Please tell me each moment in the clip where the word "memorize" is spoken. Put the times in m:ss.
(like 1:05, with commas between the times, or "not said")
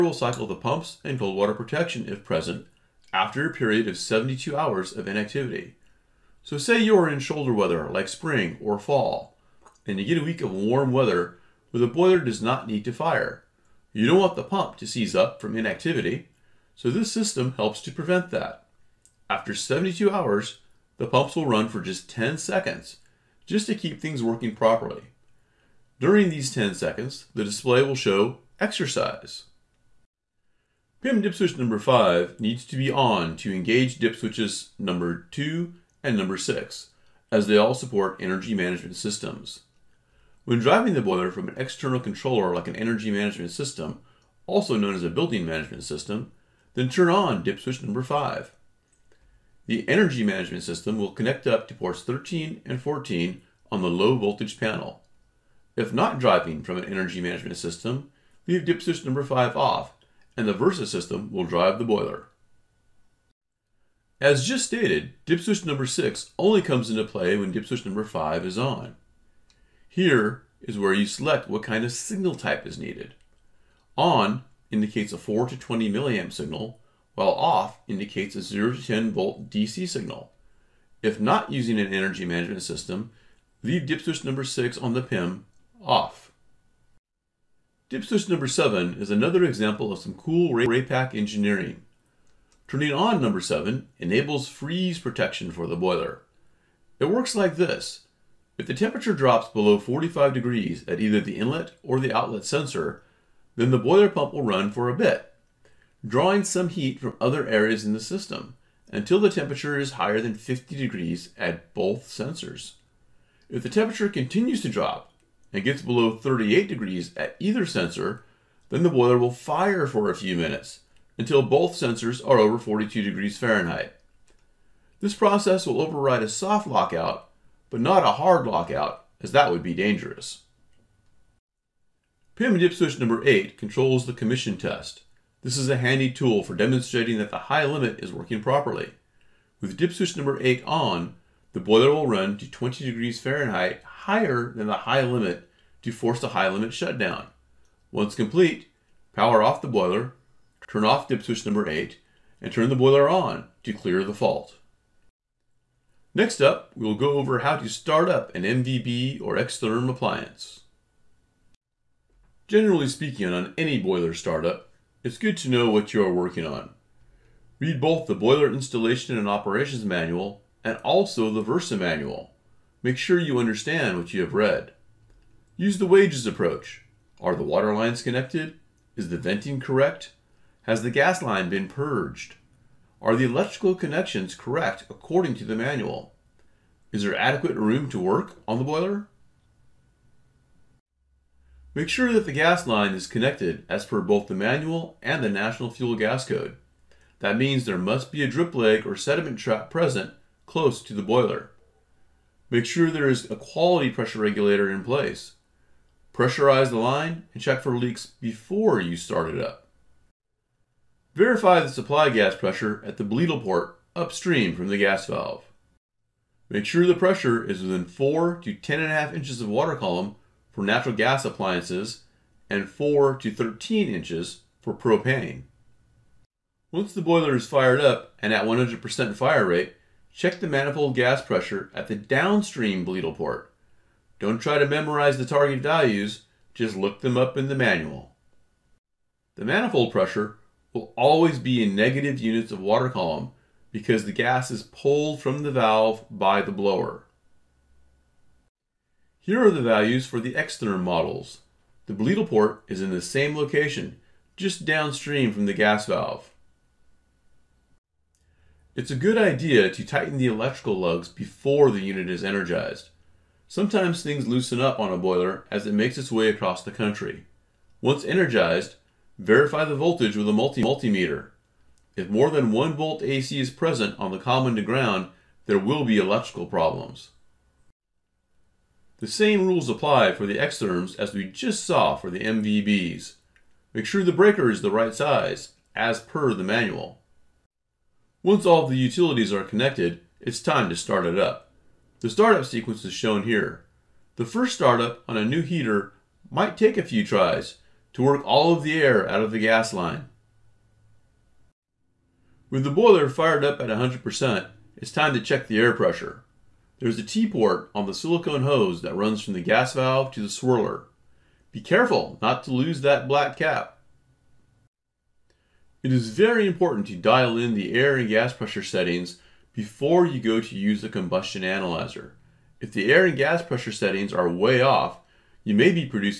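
3:54.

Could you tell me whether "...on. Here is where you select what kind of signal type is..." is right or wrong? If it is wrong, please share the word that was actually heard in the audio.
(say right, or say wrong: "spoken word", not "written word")
right.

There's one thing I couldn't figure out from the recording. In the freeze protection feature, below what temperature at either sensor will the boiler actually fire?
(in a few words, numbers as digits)
38 degrees.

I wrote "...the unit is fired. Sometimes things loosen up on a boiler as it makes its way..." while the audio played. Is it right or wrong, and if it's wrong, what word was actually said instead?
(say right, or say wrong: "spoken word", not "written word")
wrong: "energized", not "fired".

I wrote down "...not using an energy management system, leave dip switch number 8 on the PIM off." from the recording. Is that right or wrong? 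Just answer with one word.
wrong.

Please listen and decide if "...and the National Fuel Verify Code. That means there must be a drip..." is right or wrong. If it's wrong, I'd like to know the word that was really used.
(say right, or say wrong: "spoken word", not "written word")
wrong: "Gas", not "Verify".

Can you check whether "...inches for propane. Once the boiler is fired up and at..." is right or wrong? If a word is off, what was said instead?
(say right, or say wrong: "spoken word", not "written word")
right.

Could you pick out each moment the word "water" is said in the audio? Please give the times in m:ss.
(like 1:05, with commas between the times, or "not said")
0:01, 2:57, 3:39, 4:02.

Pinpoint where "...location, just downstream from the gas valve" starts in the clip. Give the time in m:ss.
4:13.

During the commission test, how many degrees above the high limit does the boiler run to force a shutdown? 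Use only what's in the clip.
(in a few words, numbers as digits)
20 degrees Fahrenheit.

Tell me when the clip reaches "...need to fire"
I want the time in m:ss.
0:12.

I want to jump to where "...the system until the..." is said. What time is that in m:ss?
1:47.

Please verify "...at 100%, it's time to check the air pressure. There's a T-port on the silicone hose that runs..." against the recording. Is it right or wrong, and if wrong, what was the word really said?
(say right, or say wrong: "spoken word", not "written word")
right.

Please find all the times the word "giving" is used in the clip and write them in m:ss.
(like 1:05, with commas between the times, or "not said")
not said.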